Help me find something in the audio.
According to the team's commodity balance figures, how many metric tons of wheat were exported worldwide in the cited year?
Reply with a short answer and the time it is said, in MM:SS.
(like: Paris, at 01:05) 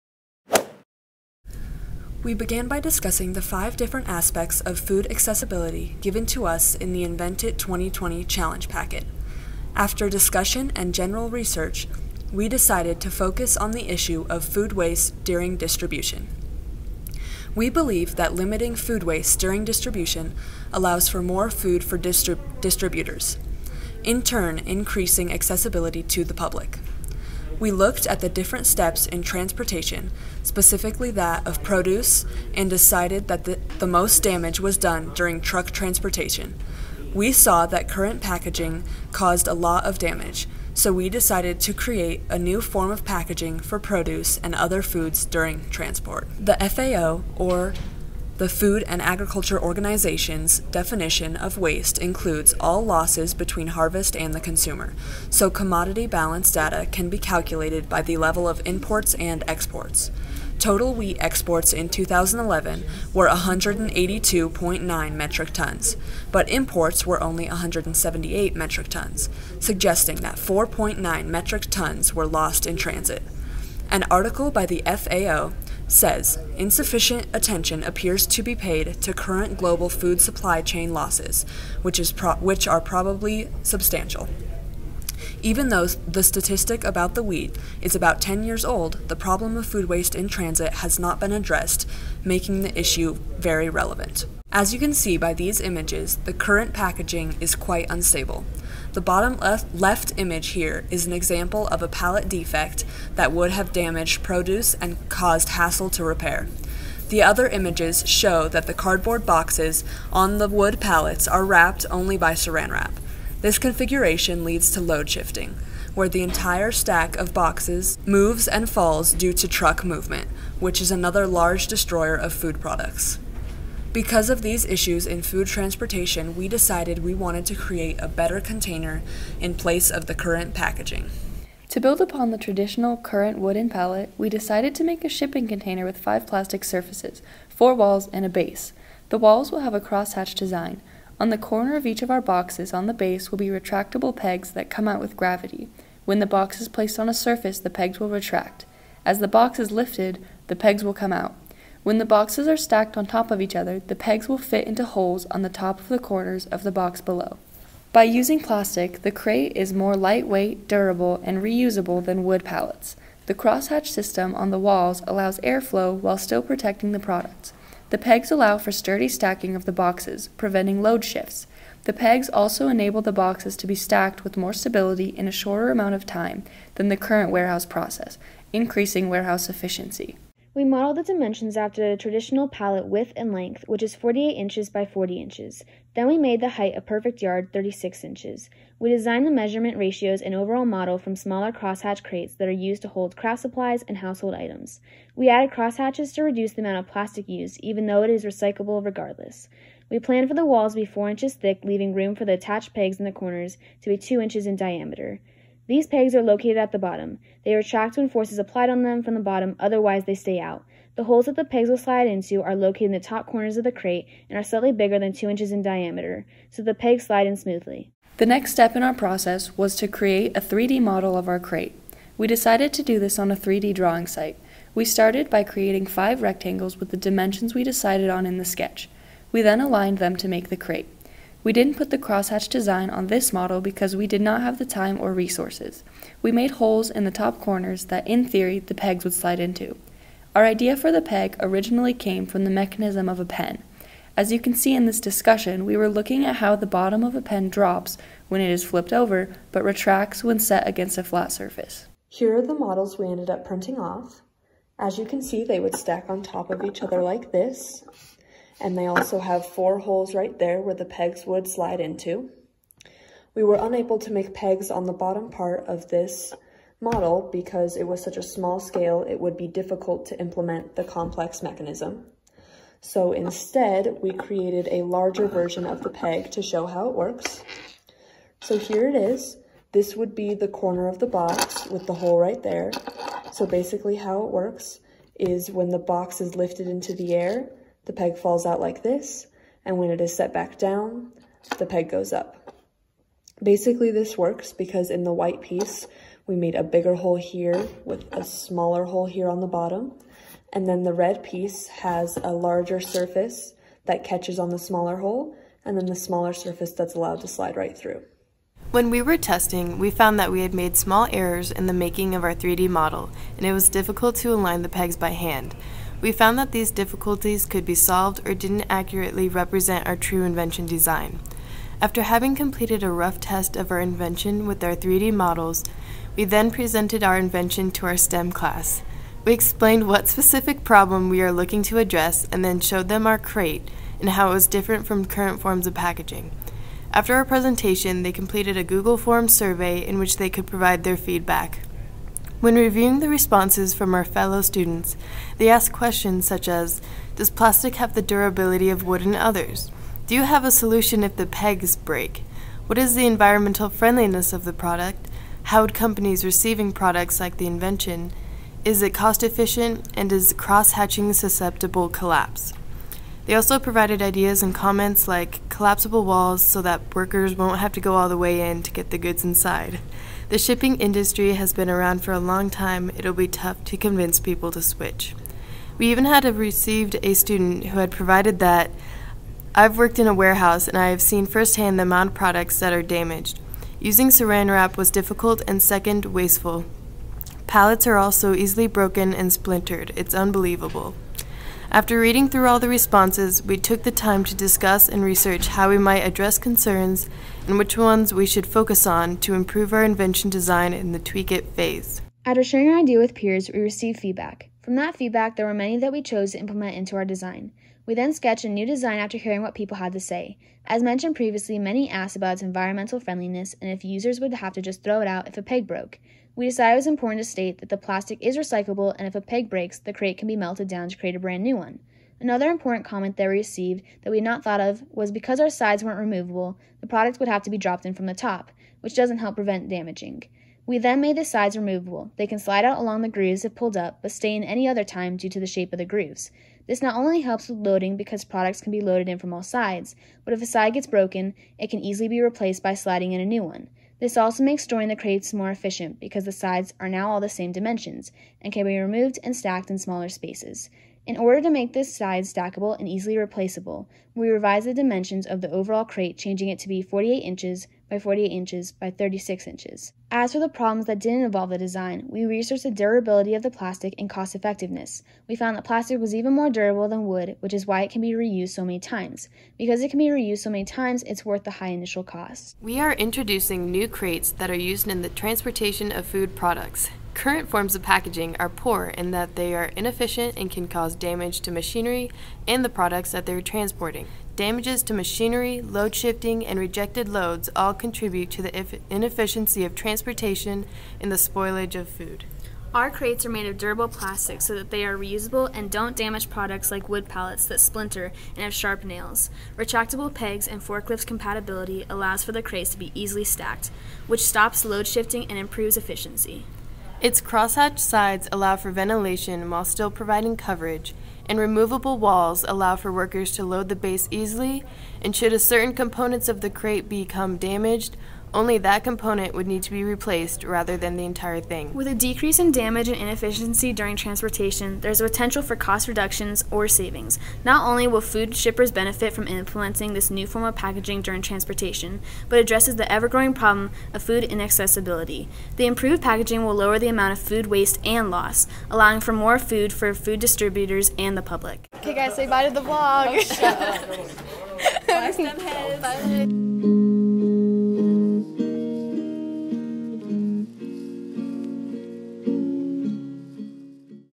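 182.9 metric tons, at 01:03.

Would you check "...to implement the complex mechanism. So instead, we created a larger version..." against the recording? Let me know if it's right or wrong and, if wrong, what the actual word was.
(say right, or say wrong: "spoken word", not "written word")
right.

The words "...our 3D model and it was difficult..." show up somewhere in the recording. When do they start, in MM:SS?
05:12.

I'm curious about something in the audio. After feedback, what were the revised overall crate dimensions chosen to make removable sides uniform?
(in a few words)
48 by 48 by 36 inches.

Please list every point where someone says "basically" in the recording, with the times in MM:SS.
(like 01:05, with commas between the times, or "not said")
04:43, 04:53.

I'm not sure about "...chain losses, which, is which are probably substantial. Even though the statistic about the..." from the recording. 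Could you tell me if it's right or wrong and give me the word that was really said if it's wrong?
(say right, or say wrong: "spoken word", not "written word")
right.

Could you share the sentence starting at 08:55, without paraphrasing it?
The improved packaging will lower the amount of food waste and loss, allowing for more food for food distributors and the public.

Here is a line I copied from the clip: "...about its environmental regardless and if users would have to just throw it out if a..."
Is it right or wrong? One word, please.
wrong.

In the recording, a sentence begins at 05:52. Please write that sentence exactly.
What is the environmental friendliness of the product?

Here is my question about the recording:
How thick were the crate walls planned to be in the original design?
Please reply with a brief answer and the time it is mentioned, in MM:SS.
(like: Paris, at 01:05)
4 inches, at 03:20.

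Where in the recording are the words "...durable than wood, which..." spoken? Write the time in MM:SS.
07:46.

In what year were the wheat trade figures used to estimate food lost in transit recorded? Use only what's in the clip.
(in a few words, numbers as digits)
2011.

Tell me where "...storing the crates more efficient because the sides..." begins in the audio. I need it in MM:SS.
07:24.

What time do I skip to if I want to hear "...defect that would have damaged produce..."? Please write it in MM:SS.
01:42.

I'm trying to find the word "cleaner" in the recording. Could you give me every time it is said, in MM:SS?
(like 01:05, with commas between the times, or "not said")
not said.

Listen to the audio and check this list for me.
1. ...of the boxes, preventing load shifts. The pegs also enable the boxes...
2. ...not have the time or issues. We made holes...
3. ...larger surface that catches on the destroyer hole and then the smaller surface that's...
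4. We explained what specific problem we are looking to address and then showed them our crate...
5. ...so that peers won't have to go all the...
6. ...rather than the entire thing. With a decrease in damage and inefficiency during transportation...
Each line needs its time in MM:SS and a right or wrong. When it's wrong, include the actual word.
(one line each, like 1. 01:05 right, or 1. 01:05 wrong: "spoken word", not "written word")
1. 02:49 right
2. 03:54 wrong: "resources", not "issues"
3. 05:02 wrong: "smaller", not "destroyer"
4. 05:29 right
5. 06:06 wrong: "workers", not "peers"
6. 08:40 right.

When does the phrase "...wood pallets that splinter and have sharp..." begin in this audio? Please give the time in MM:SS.
08:16.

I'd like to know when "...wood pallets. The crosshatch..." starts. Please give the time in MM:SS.
02:42.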